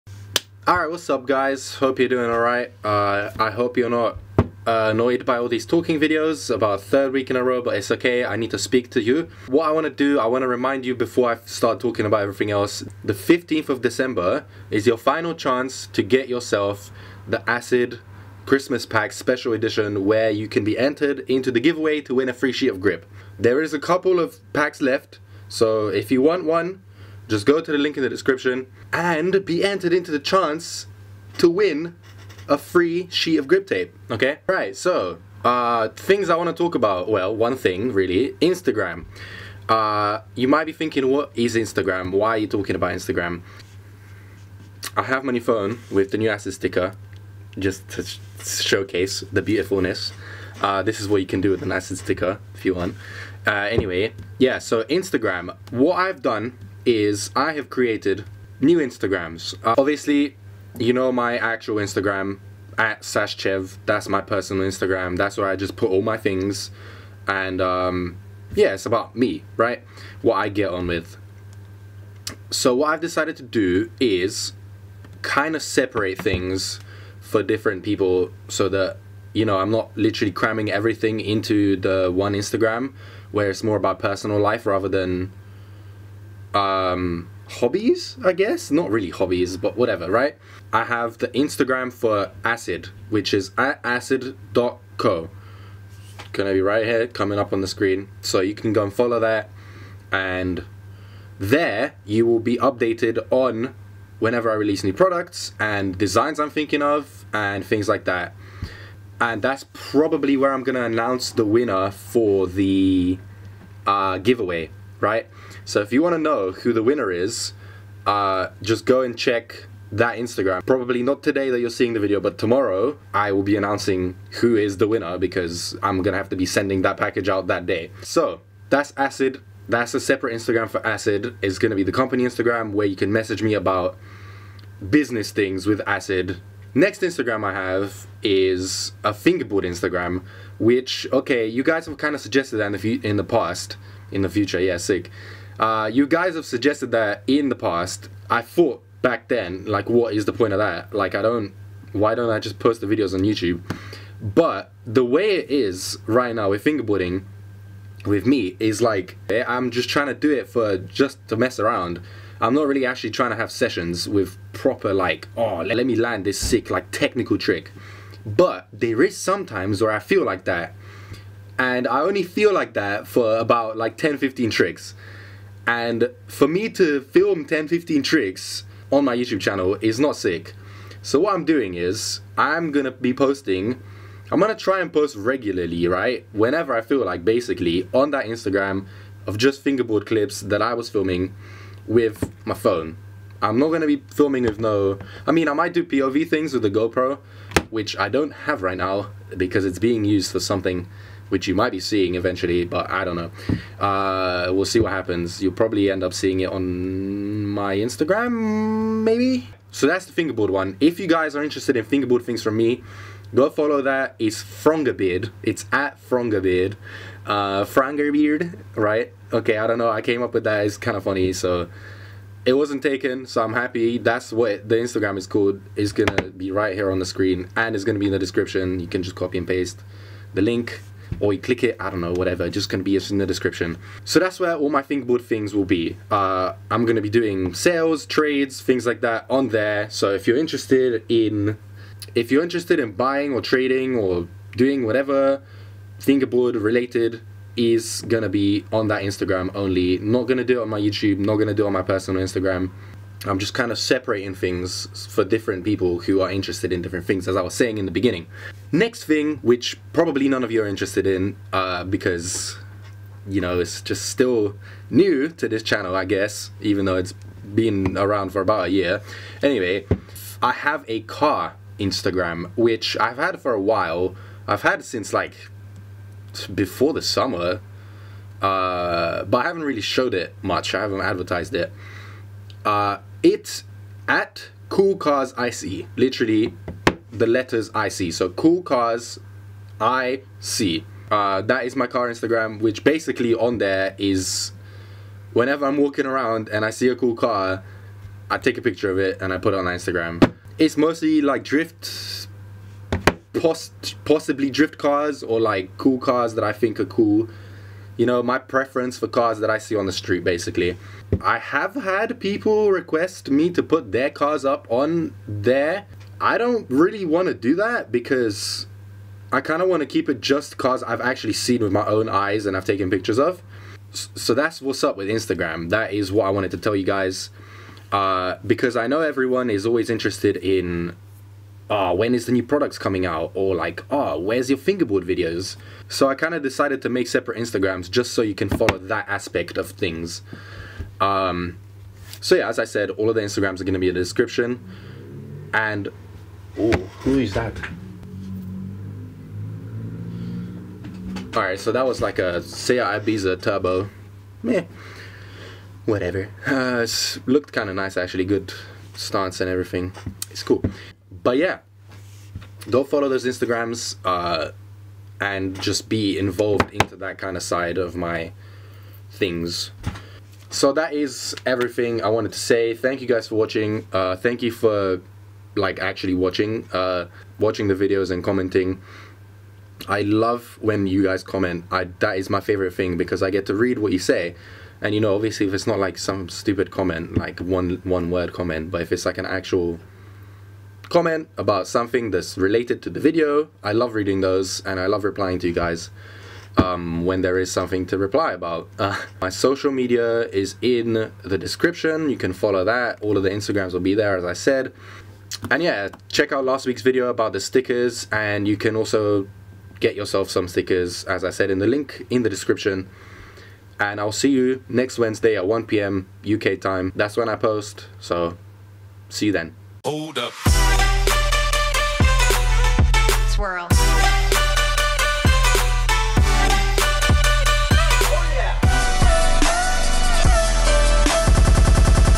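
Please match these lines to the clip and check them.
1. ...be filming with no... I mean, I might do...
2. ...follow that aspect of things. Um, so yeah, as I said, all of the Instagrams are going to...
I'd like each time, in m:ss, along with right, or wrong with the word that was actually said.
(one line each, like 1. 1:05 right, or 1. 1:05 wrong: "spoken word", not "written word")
1. 3:13 right
2. 5:38 right.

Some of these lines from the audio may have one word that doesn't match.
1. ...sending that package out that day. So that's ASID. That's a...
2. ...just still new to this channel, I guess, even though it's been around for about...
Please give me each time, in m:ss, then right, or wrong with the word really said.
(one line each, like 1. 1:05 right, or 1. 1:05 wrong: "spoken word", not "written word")
1. 2:06 right
2. 4:23 right.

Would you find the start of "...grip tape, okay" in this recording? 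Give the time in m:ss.
0:33.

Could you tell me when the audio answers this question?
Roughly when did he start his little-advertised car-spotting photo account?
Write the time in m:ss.
4:36.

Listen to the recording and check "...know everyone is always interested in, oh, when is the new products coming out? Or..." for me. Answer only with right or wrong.
right.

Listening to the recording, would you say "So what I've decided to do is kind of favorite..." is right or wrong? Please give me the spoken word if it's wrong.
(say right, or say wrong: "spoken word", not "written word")
wrong: "separate", not "favorite".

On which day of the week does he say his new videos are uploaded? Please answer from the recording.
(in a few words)
Wednesday.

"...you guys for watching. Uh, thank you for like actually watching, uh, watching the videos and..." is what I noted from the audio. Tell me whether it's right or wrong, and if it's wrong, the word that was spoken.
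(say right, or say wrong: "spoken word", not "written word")
right.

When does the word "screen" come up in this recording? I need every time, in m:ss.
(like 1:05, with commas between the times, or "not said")
1:37, 3:47.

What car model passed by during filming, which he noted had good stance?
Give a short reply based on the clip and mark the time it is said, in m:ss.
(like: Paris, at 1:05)
SEAT Ibiza Turbo, at 5:52.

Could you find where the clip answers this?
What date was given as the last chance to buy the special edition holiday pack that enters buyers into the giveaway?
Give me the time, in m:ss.
0:13.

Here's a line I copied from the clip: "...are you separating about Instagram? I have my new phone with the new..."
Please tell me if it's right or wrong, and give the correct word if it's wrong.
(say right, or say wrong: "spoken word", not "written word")
wrong: "talking", not "separating".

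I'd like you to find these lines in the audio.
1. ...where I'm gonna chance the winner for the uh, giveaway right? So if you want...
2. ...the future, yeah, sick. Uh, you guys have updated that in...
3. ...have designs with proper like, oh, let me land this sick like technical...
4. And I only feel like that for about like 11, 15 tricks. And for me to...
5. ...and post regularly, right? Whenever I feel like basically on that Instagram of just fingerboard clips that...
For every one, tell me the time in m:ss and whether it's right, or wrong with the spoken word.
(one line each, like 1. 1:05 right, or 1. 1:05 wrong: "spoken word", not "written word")
1. 1:50 wrong: "announce", not "chance"
2. 2:24 wrong: "suggested", not "updated"
3. 2:43 wrong: "sessions", not "designs"
4. 2:51 wrong: "10", not "11"
5. 3:04 right.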